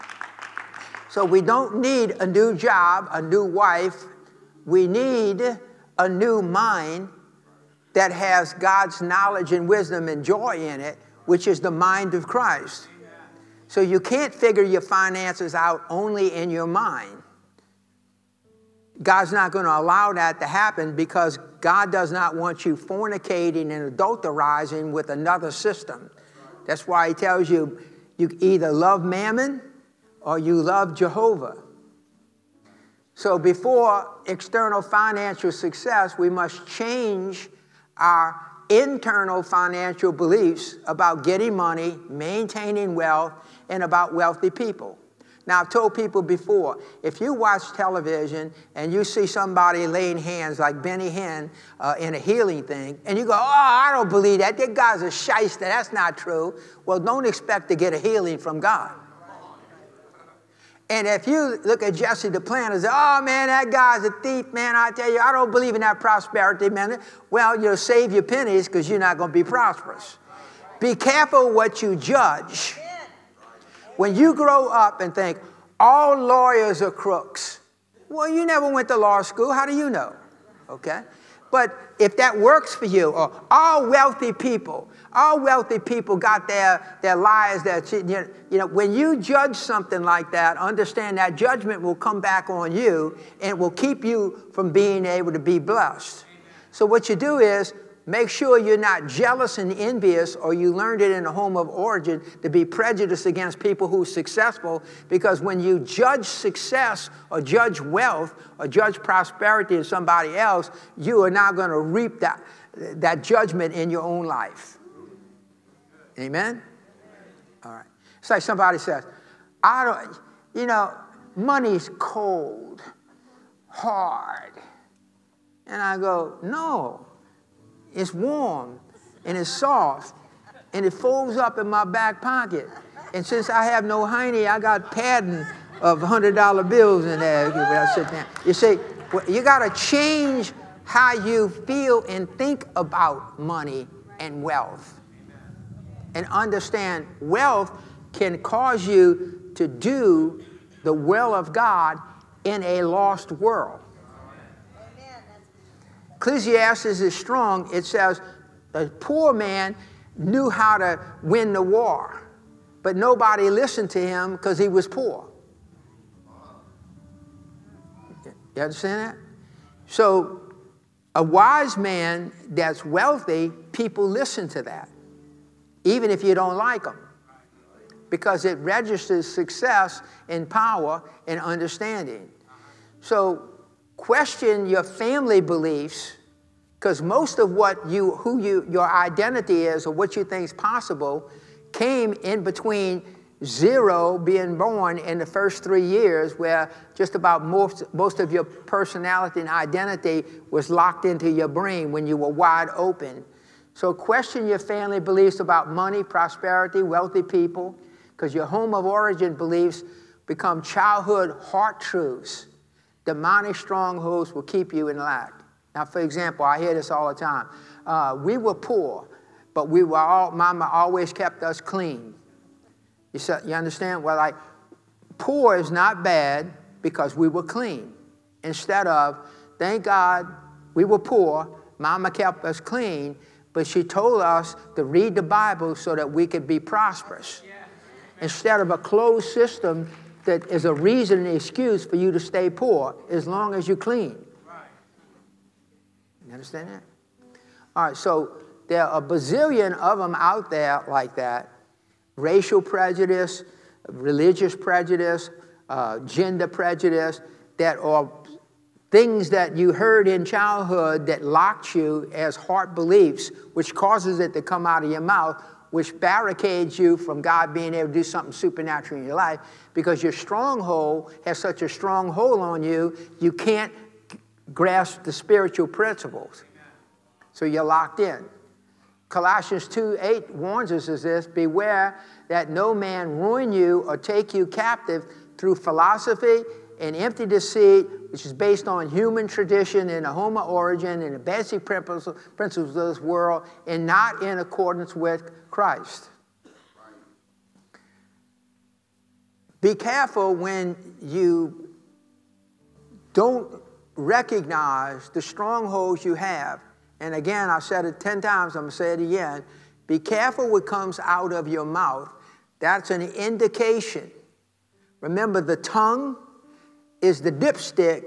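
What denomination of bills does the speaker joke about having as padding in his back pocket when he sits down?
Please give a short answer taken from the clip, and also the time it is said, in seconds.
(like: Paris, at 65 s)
$100, at 135 s.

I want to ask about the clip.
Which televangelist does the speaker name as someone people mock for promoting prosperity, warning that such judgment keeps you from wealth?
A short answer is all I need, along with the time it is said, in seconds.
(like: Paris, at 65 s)
Jesse Duplantis, at 61 s.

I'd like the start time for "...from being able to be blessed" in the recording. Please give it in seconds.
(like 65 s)
94 s.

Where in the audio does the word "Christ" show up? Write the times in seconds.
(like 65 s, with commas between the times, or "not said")
12 s, 295 s.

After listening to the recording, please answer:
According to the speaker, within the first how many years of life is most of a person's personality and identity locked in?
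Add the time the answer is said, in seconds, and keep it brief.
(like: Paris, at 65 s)
3, at 195 s.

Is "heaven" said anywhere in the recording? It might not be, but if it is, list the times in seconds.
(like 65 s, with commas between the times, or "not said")
not said.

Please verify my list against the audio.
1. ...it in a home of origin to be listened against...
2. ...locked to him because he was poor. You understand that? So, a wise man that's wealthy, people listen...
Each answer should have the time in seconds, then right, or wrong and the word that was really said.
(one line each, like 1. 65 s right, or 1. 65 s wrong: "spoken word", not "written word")
1. 101 s wrong: "prejudiced", not "listened"
2. 163 s wrong: "listened", not "locked".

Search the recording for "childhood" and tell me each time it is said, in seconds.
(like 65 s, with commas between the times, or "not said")
210 s, 260 s.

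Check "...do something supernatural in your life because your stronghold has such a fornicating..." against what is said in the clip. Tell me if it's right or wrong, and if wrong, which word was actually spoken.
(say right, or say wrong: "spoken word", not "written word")
wrong: "strong", not "fornicating".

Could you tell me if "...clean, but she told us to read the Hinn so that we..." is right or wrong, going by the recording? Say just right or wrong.
wrong.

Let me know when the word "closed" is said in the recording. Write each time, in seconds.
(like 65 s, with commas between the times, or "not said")
238 s.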